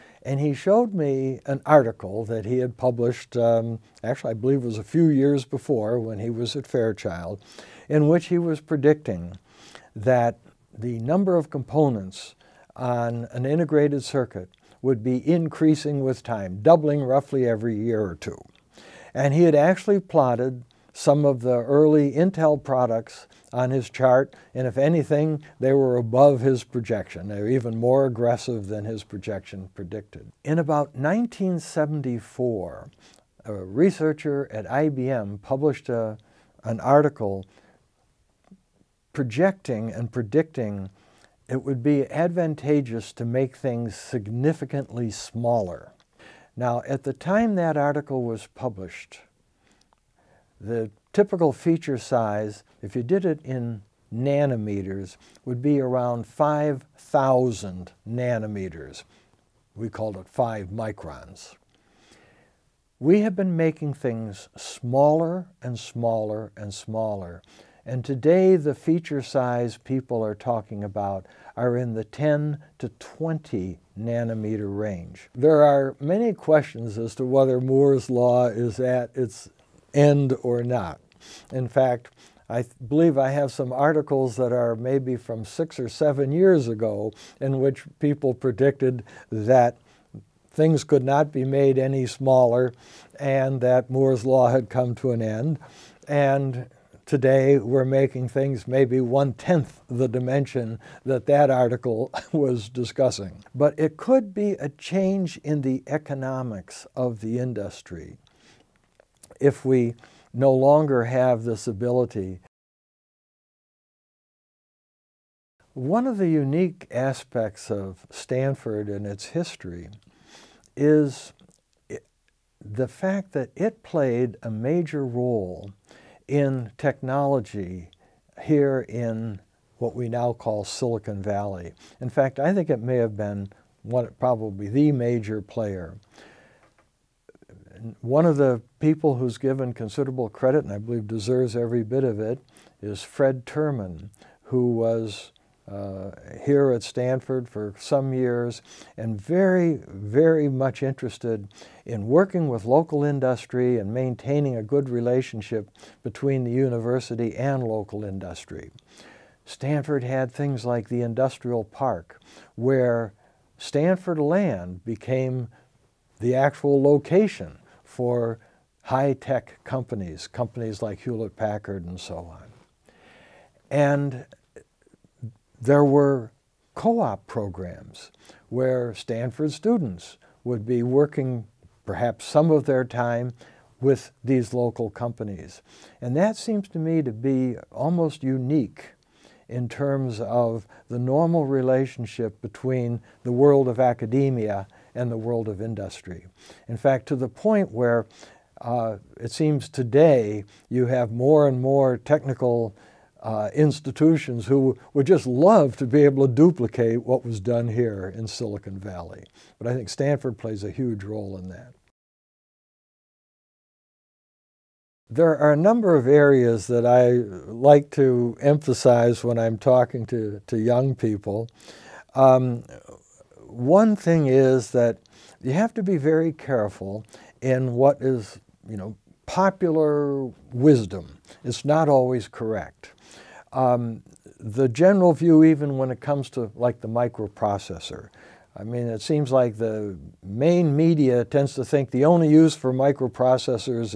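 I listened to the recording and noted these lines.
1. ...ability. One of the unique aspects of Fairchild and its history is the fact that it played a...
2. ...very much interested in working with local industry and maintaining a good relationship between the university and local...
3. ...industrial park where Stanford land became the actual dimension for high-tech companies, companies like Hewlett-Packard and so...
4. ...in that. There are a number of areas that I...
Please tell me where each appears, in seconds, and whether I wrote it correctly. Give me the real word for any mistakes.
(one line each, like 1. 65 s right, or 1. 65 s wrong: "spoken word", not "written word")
1. 111 s wrong: "Stanford", not "Fairchild"
2. 149 s right
3. 161 s wrong: "location", not "dimension"
4. 211 s right.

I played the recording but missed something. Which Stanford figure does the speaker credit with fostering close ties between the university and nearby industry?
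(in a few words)
Fred Terman.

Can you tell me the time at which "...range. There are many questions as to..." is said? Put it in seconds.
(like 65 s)
74 s.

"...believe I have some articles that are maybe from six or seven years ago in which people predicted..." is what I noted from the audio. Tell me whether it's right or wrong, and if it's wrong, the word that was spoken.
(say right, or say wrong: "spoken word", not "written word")
right.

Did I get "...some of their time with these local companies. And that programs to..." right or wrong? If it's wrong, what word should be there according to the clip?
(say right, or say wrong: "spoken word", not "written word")
wrong: "seems", not "programs".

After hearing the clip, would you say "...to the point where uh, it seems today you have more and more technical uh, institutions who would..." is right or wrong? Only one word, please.
right.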